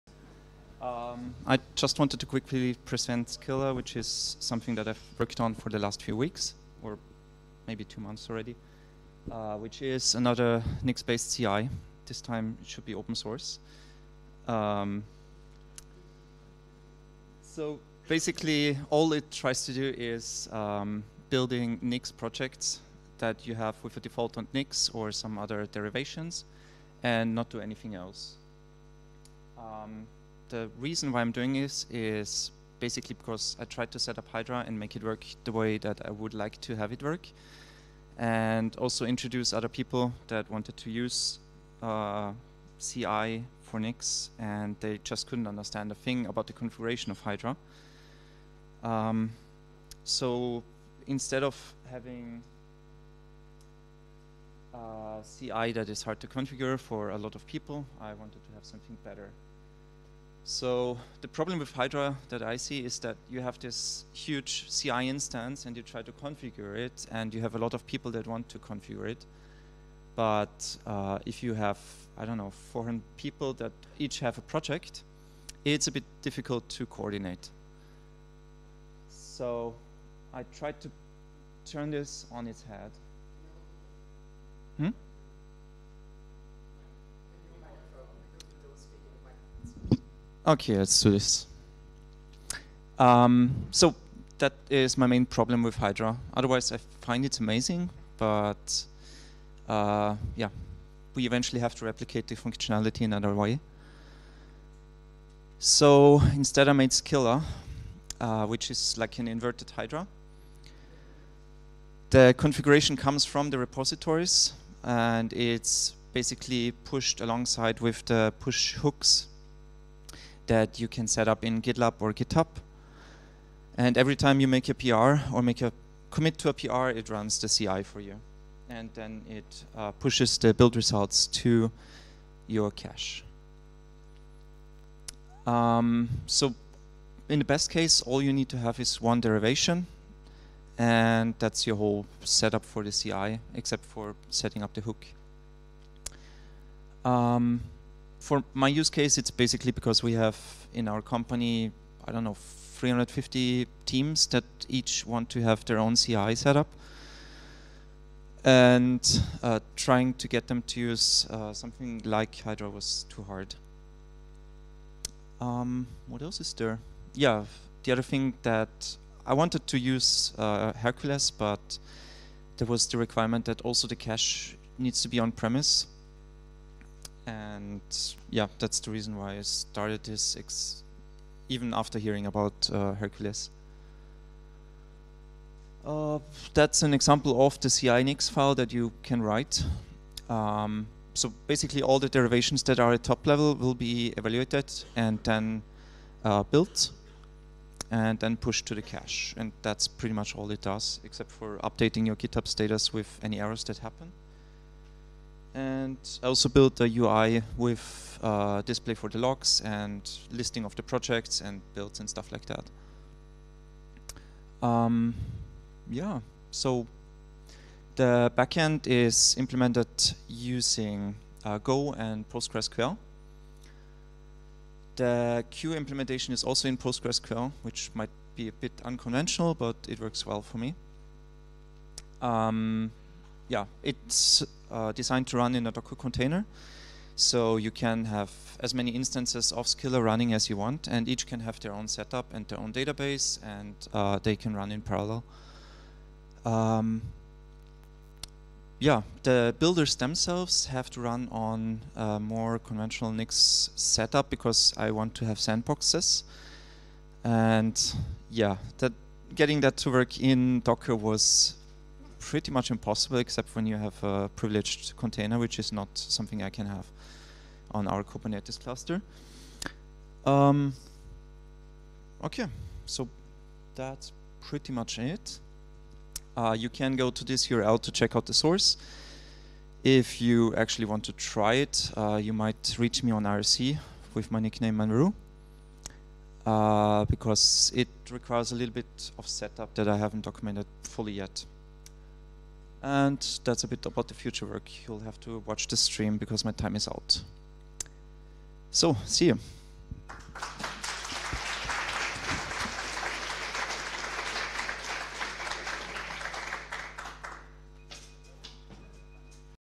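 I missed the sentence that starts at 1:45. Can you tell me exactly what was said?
So instead I made Scylla, uh, which is like an inverted Hydra.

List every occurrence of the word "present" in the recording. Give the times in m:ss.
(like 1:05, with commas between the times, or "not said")
0:02.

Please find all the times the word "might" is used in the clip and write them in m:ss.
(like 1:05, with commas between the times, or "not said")
3:47, 4:42.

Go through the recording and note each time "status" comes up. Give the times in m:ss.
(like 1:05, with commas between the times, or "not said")
3:22.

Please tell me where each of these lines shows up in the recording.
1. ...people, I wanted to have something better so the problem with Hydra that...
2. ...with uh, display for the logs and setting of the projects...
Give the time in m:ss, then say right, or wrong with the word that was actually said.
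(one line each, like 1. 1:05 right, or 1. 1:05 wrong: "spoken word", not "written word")
1. 0:57 right
2. 3:27 wrong: "listing", not "setting".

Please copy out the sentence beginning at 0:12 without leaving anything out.
This time it should be open source.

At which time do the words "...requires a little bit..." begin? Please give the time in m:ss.
4:48.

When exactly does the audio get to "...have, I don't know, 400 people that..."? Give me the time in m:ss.
1:11.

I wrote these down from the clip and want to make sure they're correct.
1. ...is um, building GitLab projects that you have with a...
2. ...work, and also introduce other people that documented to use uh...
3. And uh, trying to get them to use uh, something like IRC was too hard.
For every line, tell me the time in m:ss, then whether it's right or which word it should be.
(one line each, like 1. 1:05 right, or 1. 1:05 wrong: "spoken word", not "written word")
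1. 0:19 wrong: "Nix", not "GitLab"
2. 0:37 wrong: "wanted", not "documented"
3. 2:38 wrong: "Hydra", not "IRC".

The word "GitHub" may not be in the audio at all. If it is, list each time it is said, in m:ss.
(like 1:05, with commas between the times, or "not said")
2:02, 3:22.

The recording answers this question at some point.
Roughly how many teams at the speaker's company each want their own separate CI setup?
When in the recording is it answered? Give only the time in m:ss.
2:32.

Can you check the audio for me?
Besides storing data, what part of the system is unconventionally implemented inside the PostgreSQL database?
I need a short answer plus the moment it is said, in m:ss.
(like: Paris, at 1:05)
The queue, at 3:45.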